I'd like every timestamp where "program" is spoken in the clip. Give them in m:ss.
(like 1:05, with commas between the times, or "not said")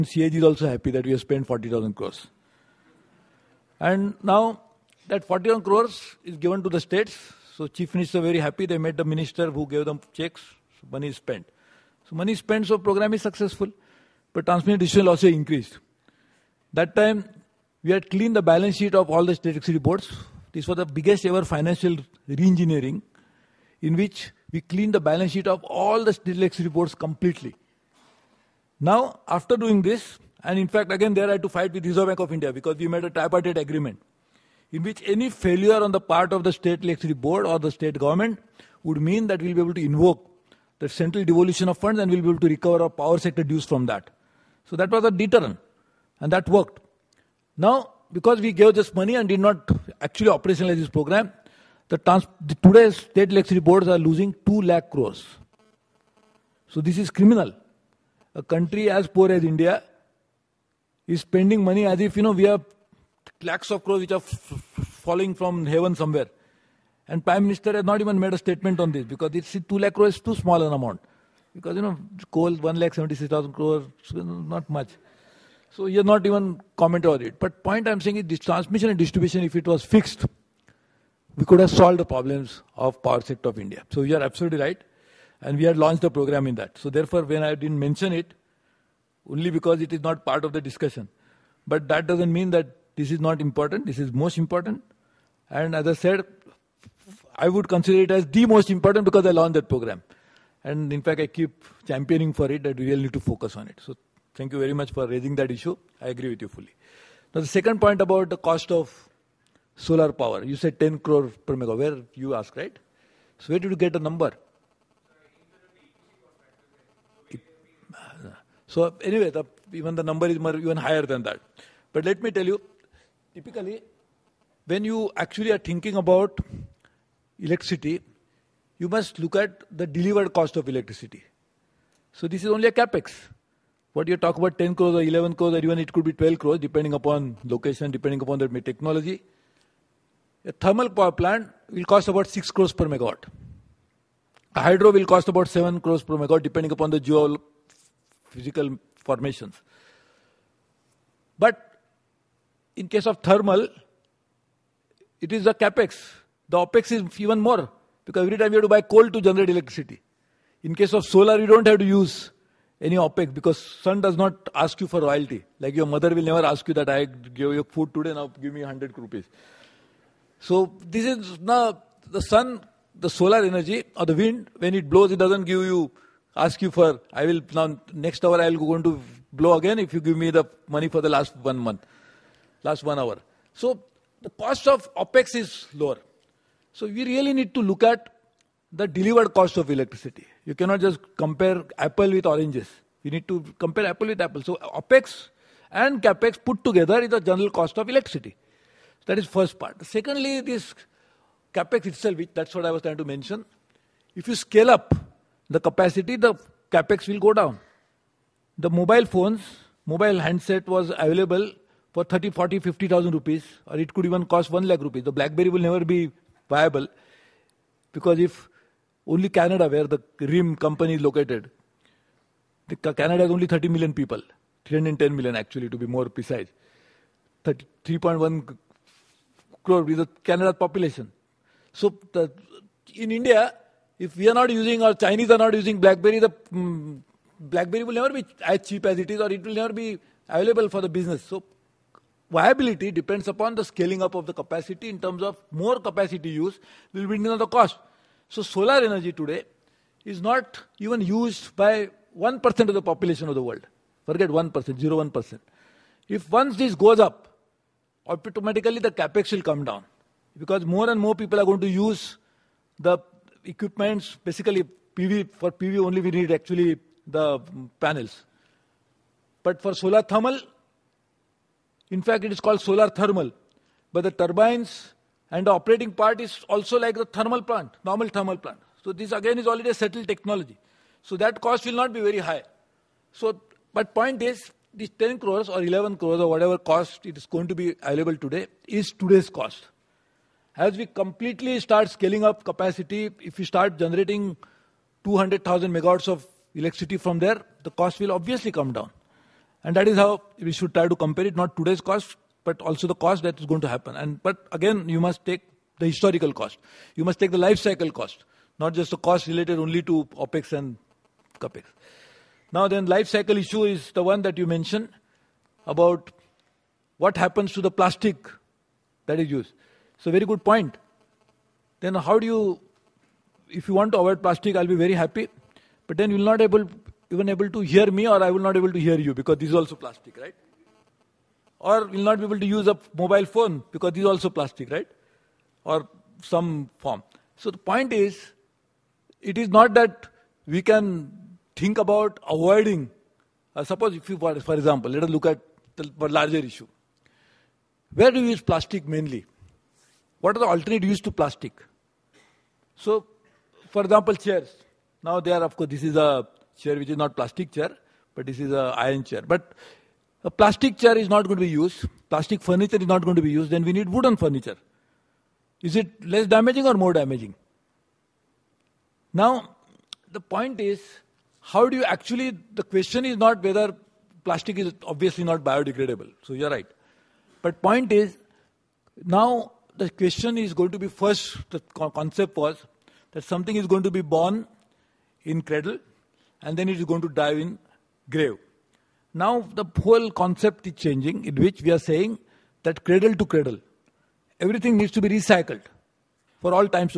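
0:12, 0:50, 1:26, 1:39.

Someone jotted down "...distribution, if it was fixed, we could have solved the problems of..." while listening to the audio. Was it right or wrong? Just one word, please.
right.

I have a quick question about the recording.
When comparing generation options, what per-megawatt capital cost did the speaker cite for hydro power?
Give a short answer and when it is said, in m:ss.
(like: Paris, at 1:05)
7 crores, at 2:25.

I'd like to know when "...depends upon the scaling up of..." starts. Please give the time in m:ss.
4:02.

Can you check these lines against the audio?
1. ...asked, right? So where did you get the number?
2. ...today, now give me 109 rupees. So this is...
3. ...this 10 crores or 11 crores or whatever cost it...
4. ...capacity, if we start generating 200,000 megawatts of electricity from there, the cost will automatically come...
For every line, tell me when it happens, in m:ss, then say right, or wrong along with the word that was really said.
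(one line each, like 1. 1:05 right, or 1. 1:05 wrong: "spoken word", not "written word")
1. 1:52 right
2. 2:47 wrong: "100", not "109"
3. 4:44 right
4. 4:52 wrong: "obviously", not "automatically".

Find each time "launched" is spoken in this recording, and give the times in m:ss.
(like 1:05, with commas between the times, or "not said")
1:25, 1:39.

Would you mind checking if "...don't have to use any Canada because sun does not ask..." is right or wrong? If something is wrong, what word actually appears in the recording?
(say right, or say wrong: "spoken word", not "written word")
wrong: "OPEX", not "Canada".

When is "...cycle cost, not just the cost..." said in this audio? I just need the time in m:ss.
5:07.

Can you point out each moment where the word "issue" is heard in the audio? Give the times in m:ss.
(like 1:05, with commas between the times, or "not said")
1:45, 5:13, 5:46.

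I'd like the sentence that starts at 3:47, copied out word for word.
3.1 crore is the Canada population.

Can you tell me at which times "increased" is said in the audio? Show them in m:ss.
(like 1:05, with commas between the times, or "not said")
0:15.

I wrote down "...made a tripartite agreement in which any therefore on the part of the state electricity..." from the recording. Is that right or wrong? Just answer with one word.
wrong.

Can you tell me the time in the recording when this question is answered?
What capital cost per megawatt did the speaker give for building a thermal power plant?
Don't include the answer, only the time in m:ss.
2:22.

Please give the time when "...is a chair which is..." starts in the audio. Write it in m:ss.
5:55.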